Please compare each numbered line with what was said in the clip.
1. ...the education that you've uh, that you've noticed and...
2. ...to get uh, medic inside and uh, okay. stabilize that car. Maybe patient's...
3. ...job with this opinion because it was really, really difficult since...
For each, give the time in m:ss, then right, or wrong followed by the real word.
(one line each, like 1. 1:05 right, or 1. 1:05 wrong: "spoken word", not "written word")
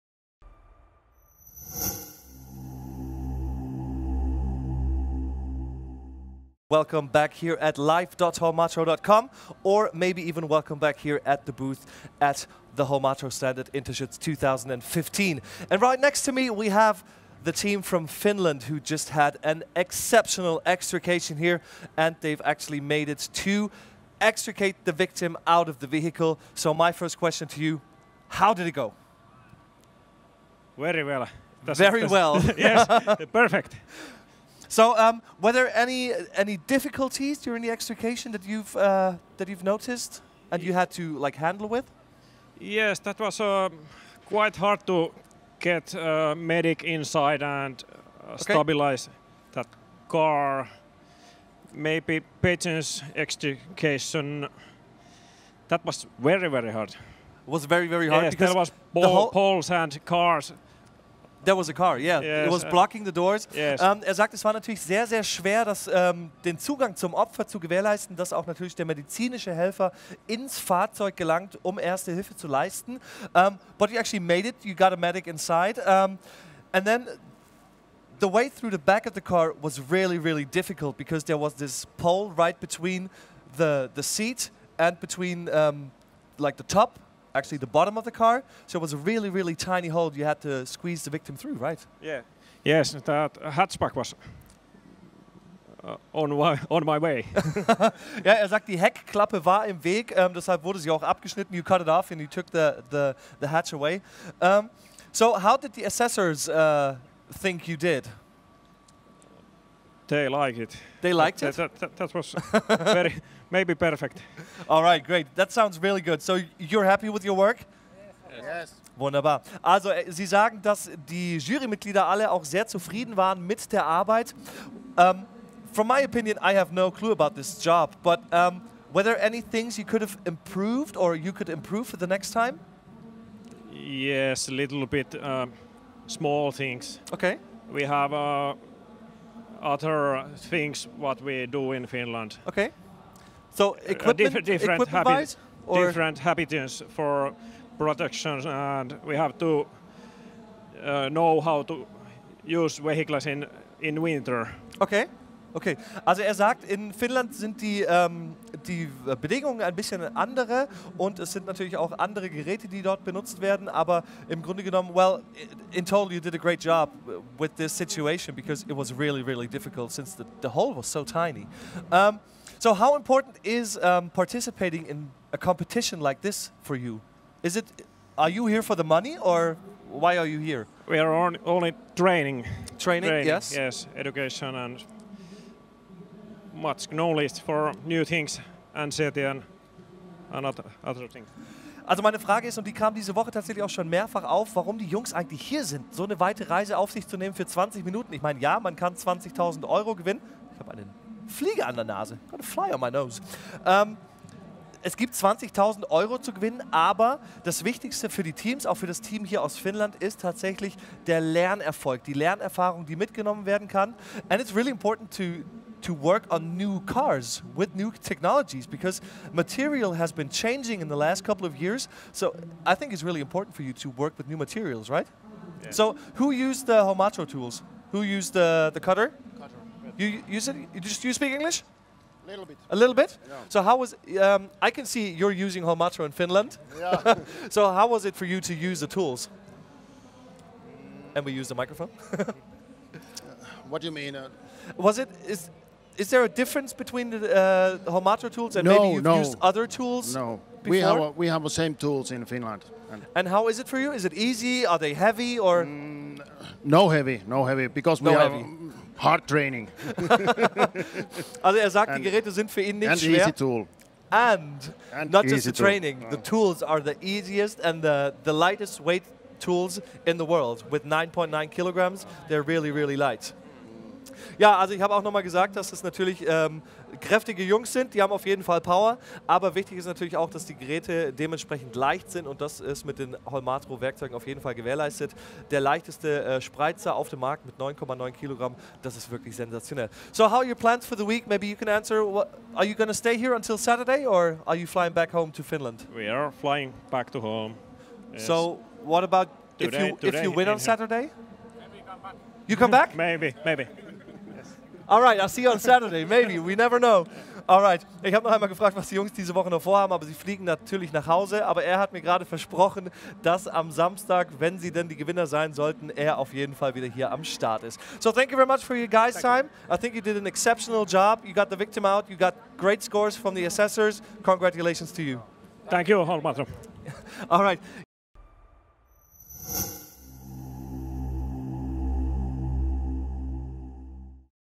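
1. 0:37 wrong: "extrication", not "education"
2. 0:44 right
3. 2:46 wrong: "situation", not "opinion".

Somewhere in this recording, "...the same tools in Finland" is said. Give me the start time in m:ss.
4:11.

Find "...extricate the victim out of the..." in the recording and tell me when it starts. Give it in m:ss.
0:24.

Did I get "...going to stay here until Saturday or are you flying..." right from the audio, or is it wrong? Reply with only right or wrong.
right.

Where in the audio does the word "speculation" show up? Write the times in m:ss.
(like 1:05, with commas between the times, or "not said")
not said.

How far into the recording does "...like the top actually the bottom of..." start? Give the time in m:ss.
1:26.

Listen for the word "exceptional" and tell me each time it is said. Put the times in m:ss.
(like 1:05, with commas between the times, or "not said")
0:19, 5:20.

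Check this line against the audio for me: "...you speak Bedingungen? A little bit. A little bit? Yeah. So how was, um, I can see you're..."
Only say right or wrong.
wrong.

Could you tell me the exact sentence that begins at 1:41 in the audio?
You cut it off and you took the, the, the hatch away.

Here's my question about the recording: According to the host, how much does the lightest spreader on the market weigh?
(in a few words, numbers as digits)
9.9 kilograms.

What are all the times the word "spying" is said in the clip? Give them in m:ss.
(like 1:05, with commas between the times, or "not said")
not said.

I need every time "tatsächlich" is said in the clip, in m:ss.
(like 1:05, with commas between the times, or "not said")
3:13, 3:30.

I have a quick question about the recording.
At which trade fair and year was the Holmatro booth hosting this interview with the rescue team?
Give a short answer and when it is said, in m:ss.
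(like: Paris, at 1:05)
Interschutz 2015, at 0:13.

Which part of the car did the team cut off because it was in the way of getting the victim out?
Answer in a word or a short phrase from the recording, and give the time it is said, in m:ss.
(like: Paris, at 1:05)
hatchback, at 1:33.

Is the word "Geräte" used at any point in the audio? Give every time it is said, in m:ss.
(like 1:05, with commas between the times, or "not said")
2:42, 4:22, 4:40.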